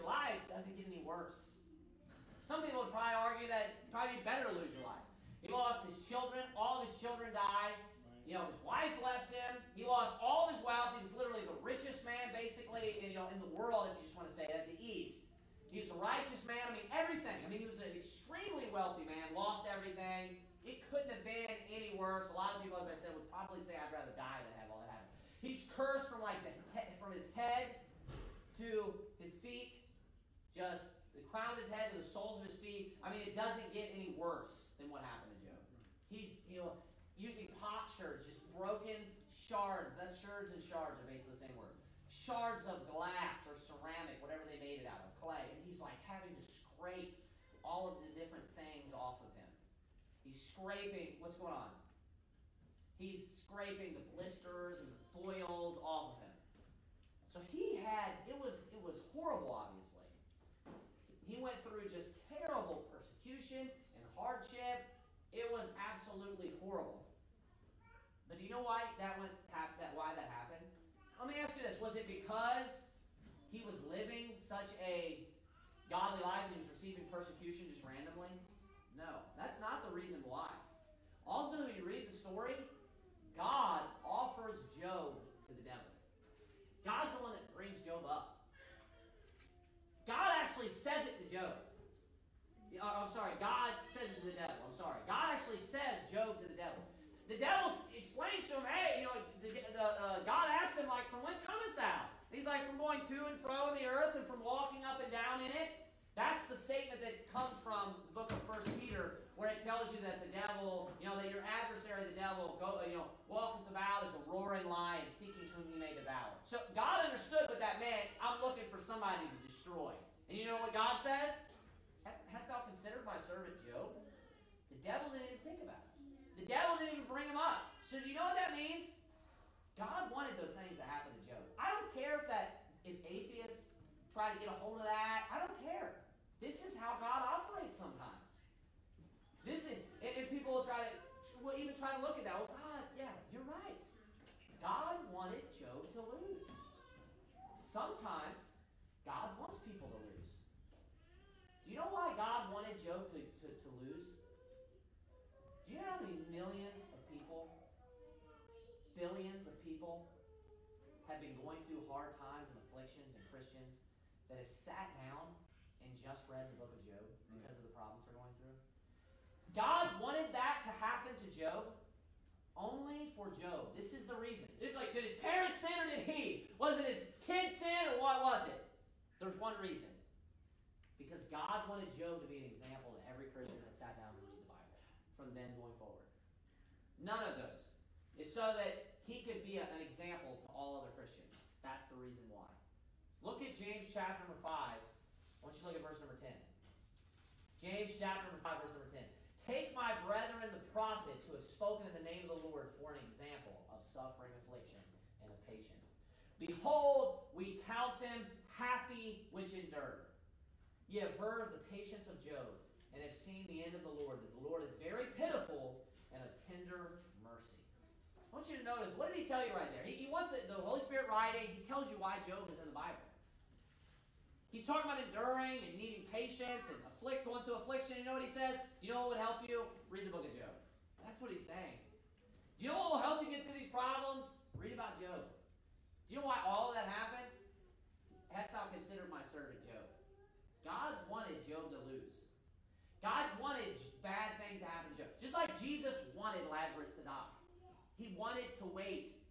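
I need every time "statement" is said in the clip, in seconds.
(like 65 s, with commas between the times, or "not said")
106 s.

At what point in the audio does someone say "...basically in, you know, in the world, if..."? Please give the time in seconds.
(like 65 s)
12 s.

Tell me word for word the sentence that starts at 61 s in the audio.
He went through just terrible persecution and hardship.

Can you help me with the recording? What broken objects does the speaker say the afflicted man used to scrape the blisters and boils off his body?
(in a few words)
Pot shards.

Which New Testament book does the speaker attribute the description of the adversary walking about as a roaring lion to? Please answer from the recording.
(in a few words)
First Peter.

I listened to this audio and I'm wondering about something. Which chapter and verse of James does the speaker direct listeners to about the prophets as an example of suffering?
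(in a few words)
Chapter 5, verse 10.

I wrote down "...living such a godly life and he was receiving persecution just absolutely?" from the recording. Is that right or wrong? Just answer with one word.
wrong.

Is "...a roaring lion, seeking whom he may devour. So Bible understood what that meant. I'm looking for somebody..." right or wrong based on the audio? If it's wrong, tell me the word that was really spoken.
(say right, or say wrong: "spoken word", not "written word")
wrong: "God", not "Bible".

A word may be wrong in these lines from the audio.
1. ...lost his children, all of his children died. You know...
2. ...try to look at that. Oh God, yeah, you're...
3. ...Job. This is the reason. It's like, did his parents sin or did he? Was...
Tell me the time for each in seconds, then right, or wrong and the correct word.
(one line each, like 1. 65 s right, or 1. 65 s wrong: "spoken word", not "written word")
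1. 5 s right
2. 141 s right
3. 173 s right.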